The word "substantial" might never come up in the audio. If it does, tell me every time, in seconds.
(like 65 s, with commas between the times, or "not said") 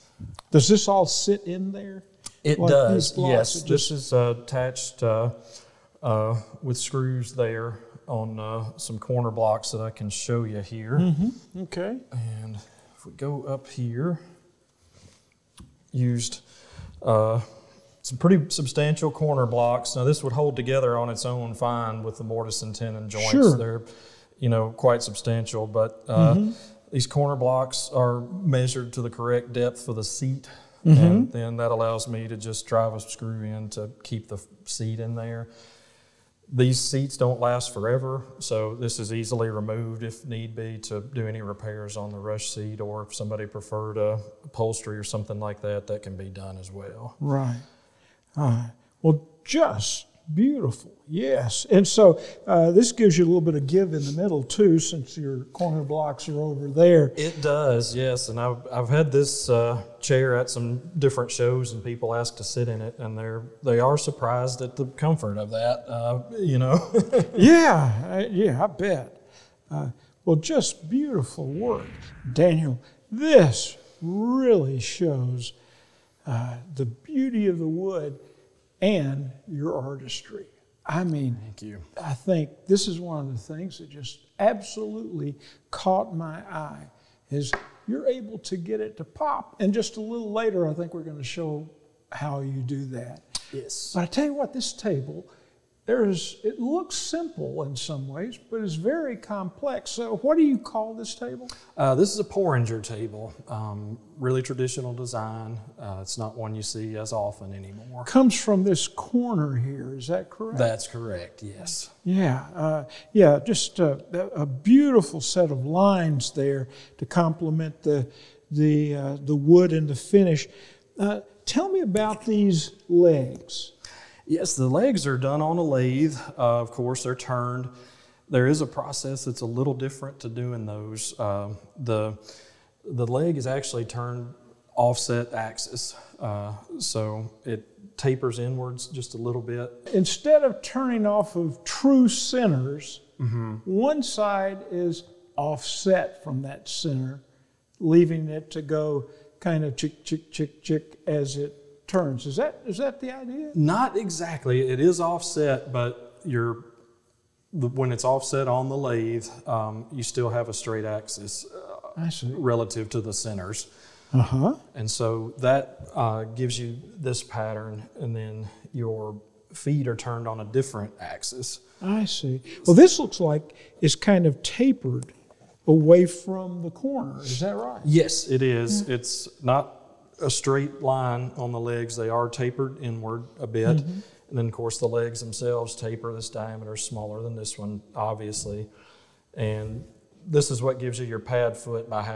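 18 s, 25 s.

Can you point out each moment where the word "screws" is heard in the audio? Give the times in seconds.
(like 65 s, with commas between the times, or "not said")
6 s, 33 s.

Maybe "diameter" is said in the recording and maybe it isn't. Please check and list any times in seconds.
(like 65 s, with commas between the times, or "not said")
186 s.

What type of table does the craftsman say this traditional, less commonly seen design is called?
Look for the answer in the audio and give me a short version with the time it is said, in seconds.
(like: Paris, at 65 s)
porringer table, at 102 s.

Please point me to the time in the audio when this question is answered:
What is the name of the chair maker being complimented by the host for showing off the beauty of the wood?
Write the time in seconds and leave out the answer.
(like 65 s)
72 s.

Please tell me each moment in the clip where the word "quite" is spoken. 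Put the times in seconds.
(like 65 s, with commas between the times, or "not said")
24 s.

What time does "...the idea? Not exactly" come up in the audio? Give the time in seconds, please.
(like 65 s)
153 s.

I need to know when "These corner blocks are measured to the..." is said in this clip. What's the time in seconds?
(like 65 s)
26 s.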